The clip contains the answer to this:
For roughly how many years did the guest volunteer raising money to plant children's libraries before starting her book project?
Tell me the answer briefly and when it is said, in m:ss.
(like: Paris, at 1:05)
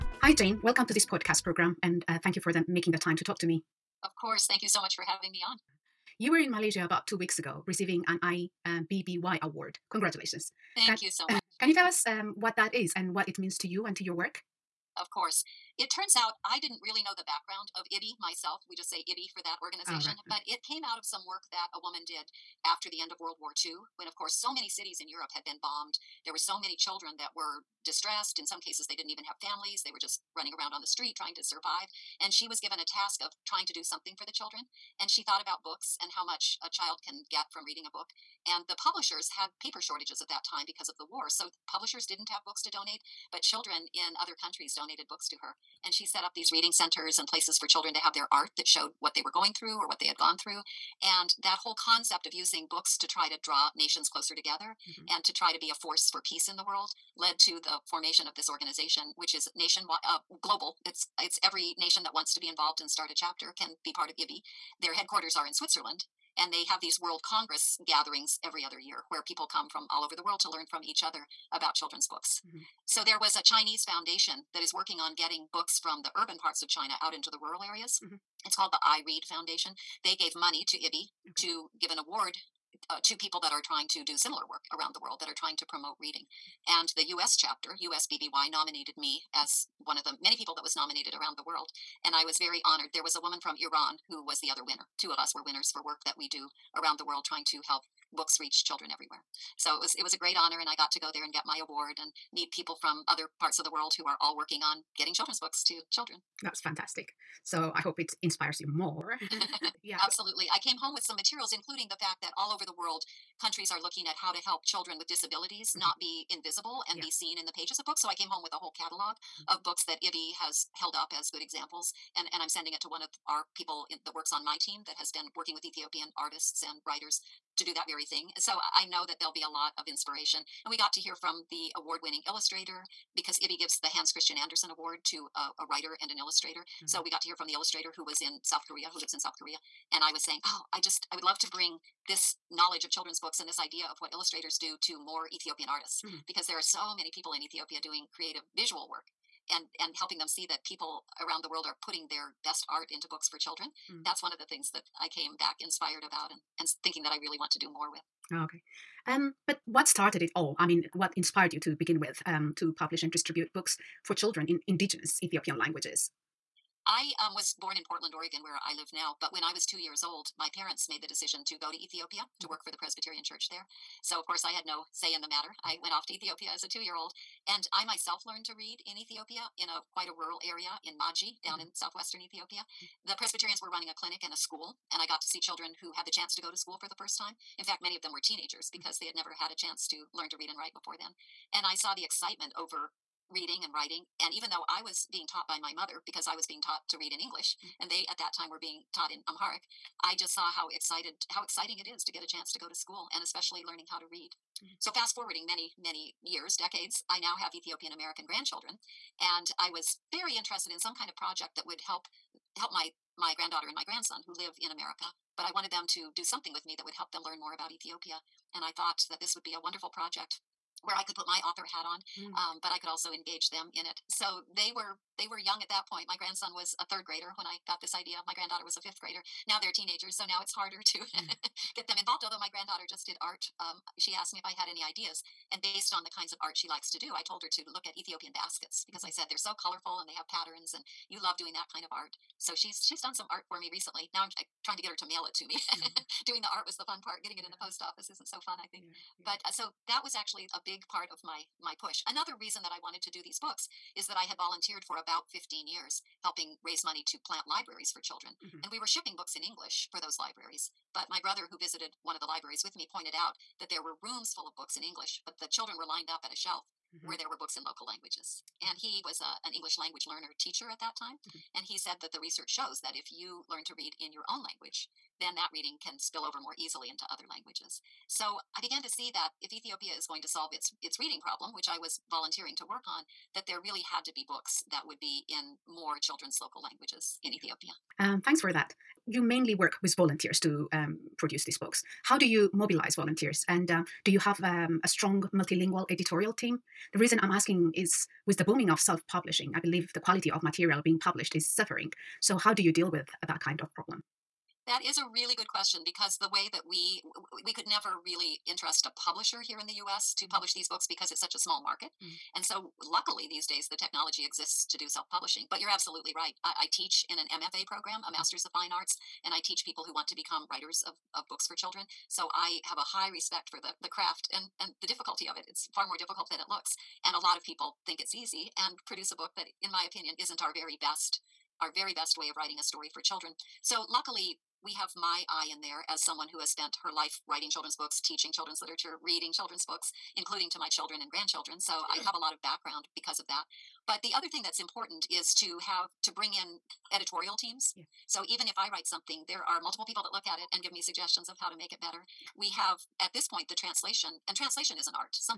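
15 years, at 4:15.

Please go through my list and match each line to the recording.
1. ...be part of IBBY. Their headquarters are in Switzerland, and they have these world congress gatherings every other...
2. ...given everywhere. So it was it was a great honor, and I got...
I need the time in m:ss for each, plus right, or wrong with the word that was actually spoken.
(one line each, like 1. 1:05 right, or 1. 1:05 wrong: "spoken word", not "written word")
1. 1:03 right
2. 1:38 wrong: "children", not "given".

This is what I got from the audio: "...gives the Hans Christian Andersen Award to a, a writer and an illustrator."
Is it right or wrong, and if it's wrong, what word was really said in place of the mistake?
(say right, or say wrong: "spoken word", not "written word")
right.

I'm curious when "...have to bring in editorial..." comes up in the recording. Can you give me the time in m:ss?
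5:45.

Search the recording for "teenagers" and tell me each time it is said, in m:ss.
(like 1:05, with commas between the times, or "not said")
3:08, 3:49.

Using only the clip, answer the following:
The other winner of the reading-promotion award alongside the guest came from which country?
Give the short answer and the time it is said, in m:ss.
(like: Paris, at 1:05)
Iran, at 1:33.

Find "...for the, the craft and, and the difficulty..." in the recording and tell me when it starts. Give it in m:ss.
5:23.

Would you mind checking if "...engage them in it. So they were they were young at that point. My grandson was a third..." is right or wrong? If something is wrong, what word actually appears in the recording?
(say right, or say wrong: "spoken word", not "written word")
right.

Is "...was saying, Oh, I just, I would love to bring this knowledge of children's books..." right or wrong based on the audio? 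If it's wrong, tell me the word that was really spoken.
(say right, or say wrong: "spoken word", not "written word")
right.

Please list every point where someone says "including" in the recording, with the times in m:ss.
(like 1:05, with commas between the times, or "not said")
1:51, 5:40.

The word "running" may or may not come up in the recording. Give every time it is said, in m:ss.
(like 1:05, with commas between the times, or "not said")
0:30, 3:03.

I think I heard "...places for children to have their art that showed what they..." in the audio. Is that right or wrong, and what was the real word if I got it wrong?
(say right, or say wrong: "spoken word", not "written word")
right.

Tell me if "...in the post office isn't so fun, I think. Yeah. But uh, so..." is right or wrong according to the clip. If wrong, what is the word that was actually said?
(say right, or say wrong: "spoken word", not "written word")
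right.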